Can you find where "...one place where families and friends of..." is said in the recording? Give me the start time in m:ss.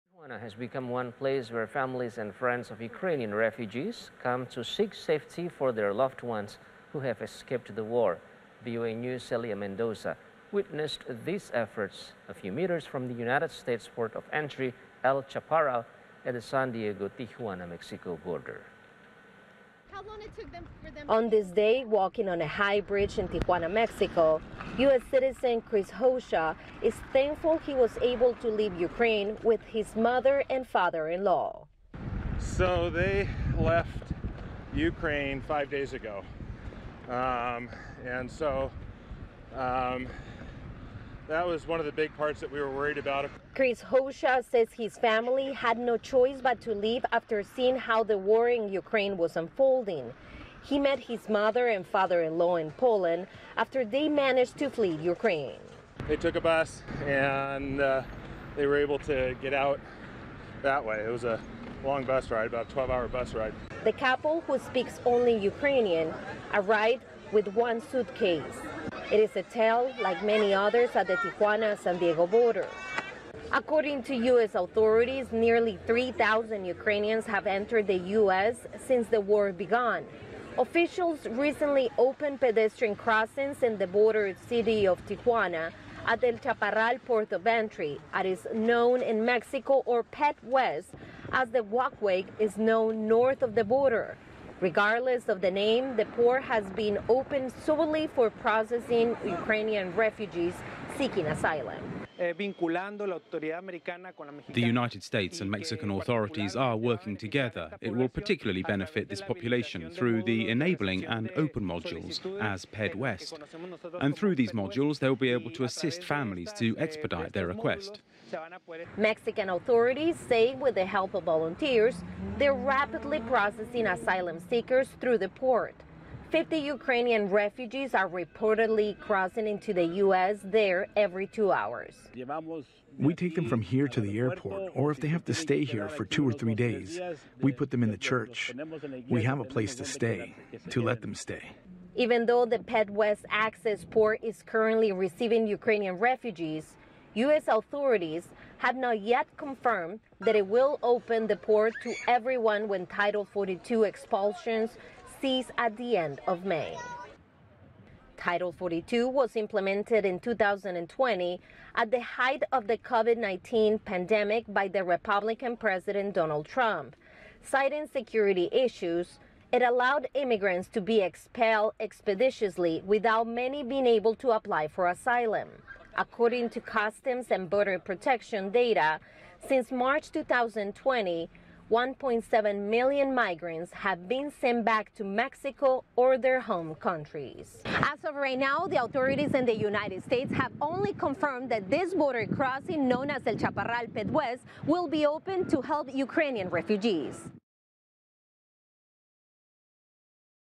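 0:00.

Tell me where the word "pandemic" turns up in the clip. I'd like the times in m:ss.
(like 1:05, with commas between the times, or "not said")
2:43.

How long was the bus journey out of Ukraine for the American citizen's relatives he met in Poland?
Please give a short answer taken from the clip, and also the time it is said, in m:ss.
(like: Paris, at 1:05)
12 hours, at 1:02.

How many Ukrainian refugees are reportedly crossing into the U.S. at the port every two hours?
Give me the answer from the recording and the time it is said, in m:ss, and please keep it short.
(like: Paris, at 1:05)
50, at 2:06.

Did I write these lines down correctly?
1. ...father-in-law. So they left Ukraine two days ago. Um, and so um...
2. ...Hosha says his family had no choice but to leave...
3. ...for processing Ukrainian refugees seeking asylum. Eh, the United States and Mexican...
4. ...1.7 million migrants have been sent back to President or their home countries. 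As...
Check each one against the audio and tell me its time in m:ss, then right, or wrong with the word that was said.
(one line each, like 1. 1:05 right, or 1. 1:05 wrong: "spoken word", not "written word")
1. 0:30 wrong: "five", not "two"
2. 0:43 right
3. 1:38 right
4. 3:01 wrong: "Mexico", not "President".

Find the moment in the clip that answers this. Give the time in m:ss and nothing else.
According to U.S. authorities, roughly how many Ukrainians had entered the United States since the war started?
1:15.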